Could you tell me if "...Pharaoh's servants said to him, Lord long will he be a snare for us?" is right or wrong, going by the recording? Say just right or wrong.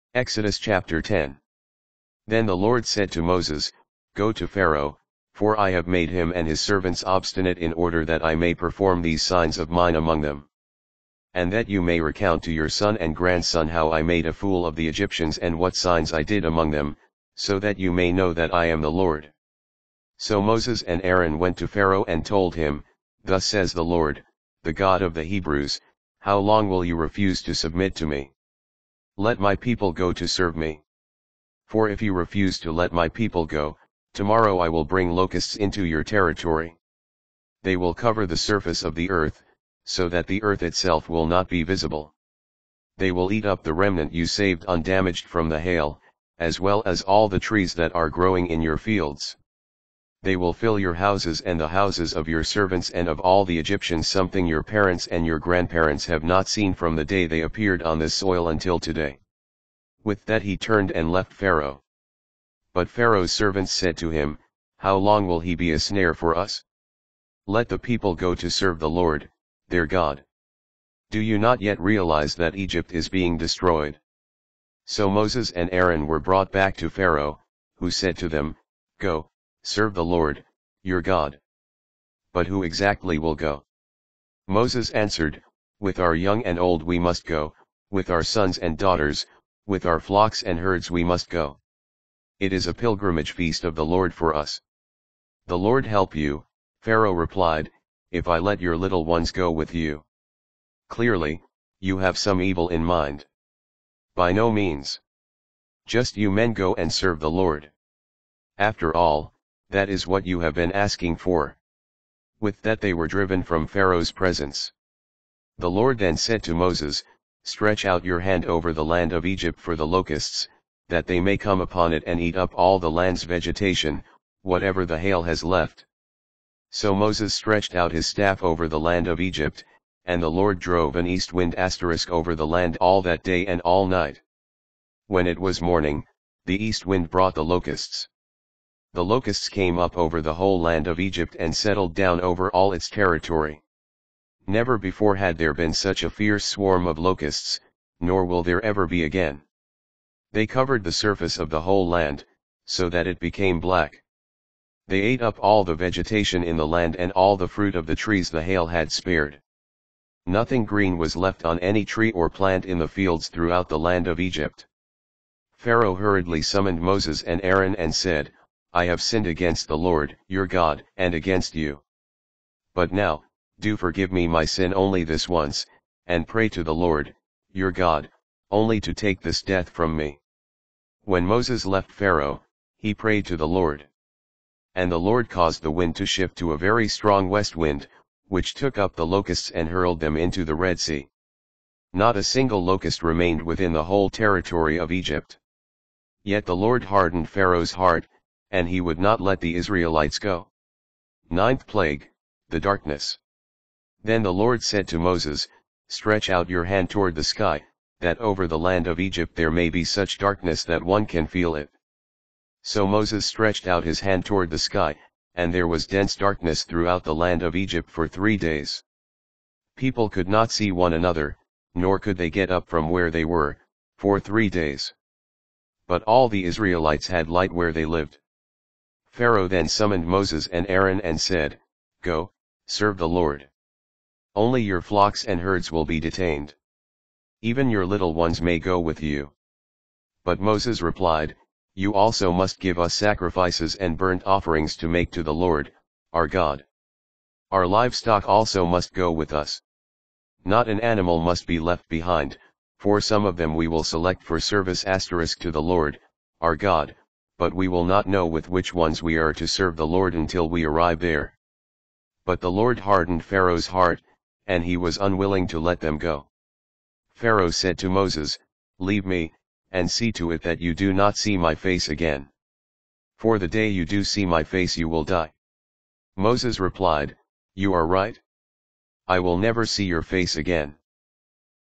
wrong.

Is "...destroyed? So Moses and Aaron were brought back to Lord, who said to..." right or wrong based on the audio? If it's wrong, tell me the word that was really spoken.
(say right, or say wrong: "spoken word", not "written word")
wrong: "Pharaoh", not "Lord".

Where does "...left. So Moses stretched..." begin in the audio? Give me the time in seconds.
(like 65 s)
125 s.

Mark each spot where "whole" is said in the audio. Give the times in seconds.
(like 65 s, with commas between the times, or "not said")
140 s, 151 s, 193 s.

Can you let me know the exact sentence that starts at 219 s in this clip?
People could not see one another, nor could they get up from where they were, for three days.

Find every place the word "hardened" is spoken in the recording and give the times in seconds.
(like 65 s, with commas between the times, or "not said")
196 s, 262 s.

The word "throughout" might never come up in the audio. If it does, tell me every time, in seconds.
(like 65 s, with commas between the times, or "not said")
163 s, 216 s.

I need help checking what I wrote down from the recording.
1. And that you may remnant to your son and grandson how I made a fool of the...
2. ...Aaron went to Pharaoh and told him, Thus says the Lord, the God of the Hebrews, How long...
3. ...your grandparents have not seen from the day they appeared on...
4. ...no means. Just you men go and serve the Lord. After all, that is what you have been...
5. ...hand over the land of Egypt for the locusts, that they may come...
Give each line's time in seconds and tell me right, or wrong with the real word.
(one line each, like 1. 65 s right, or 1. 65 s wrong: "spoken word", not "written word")
1. 11 s wrong: "recount", not "remnant"
2. 21 s right
3. 55 s right
4. 104 s right
5. 118 s right.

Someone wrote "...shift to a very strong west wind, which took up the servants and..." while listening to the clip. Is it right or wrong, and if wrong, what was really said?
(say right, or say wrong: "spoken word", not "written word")
wrong: "locusts", not "servants".